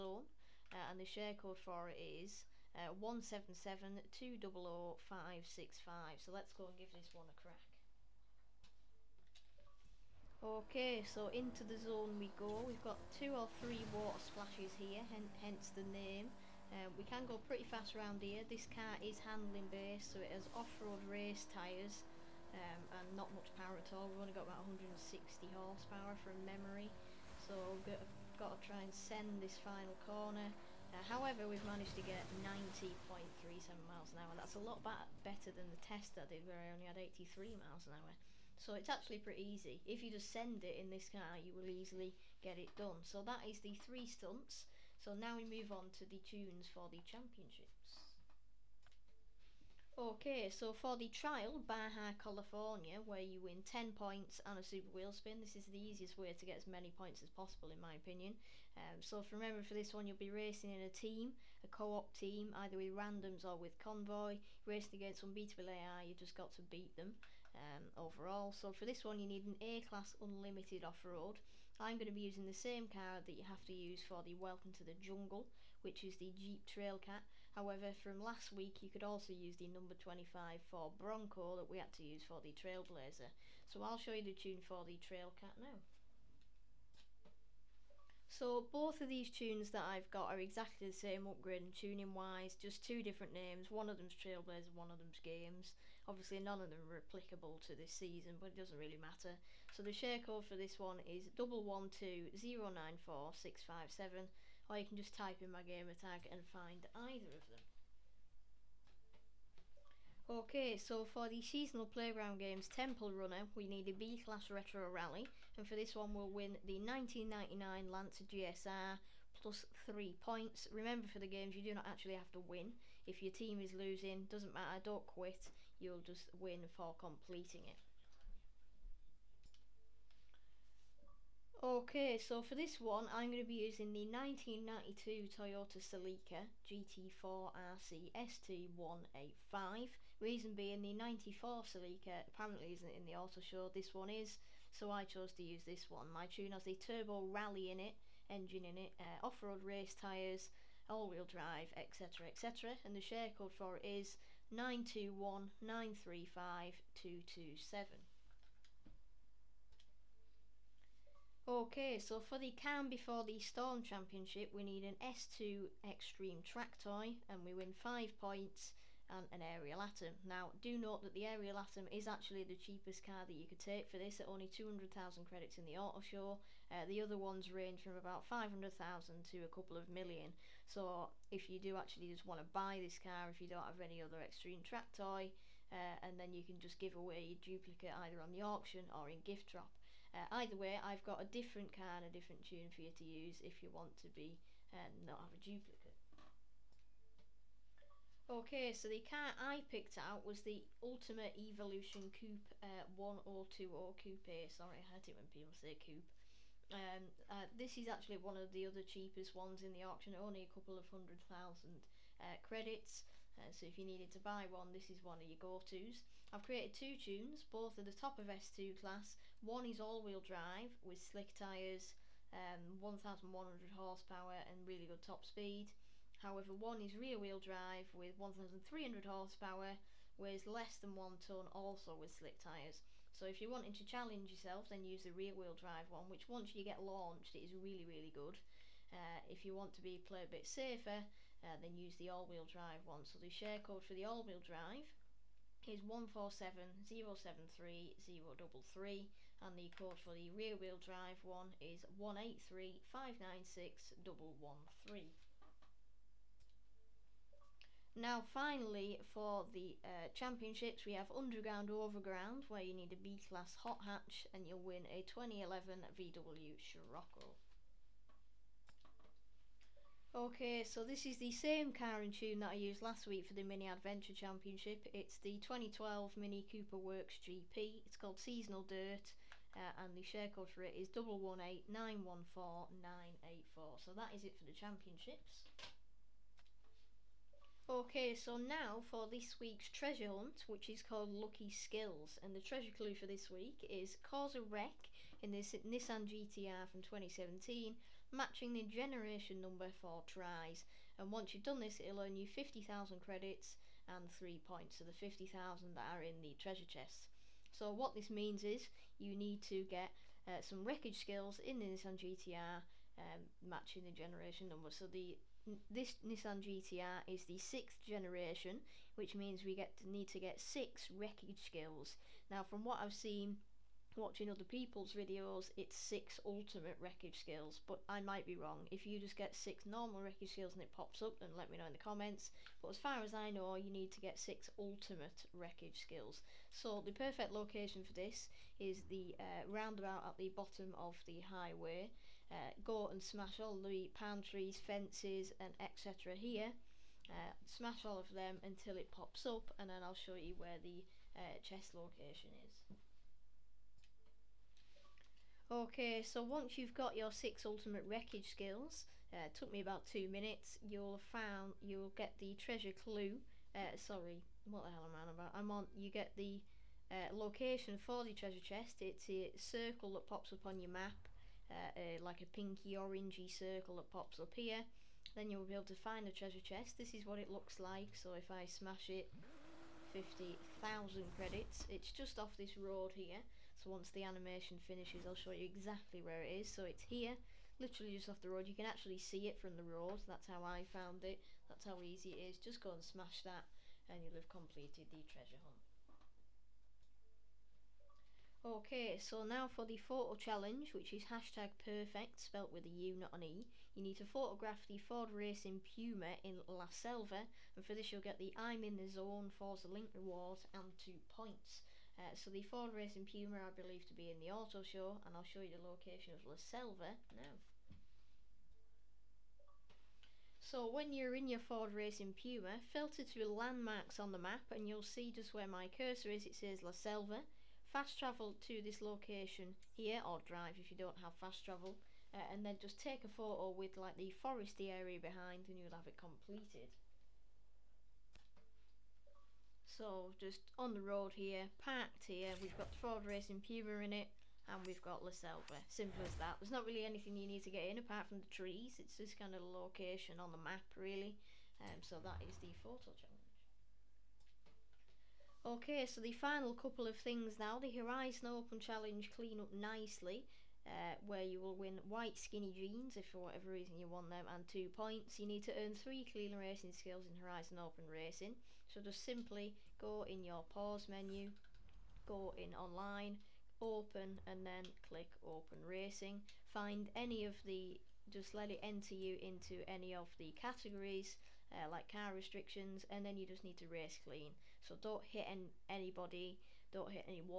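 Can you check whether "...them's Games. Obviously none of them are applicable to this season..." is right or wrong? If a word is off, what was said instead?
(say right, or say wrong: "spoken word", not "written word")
right.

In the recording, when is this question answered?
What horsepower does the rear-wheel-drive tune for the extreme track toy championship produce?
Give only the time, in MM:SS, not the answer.
03:48.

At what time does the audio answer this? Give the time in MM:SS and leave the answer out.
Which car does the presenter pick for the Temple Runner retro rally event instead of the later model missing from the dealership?
02:14.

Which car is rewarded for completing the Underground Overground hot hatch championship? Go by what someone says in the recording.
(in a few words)
2011 VW Scirocco.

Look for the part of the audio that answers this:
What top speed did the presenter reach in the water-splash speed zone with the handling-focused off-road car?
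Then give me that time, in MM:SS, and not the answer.
00:32.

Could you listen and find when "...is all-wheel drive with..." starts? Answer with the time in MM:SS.
03:39.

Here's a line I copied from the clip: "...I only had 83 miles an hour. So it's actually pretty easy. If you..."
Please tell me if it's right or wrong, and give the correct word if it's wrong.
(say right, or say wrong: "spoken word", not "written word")
right.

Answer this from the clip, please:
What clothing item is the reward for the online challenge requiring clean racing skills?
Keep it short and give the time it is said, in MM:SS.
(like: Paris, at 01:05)
white skinny jeans, at 07:41.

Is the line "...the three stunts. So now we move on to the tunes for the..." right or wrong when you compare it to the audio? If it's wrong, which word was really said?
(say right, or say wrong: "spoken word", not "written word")
right.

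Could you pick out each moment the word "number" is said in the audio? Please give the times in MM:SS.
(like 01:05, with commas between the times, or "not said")
01:19, 04:59, 05:14.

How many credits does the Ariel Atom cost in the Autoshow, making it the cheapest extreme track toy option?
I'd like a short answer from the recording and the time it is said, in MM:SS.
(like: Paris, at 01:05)
200,000, at 02:54.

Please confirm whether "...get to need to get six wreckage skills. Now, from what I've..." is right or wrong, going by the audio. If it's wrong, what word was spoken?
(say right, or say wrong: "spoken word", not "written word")
right.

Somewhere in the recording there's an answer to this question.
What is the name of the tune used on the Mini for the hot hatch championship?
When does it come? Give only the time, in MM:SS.
04:38.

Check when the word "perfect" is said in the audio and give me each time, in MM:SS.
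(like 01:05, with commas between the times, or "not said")
05:36, 06:41.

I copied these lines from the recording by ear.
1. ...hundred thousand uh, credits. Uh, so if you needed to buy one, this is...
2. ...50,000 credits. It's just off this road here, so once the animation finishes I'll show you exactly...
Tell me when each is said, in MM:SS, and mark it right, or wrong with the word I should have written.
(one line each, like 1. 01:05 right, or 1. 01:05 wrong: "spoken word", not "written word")
1. 03:30 right
2. 06:19 right.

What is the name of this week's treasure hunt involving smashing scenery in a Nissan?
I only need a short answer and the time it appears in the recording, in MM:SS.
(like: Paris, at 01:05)
Lucky Skills, at 04:51.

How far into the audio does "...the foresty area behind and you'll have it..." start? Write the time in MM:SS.
07:13.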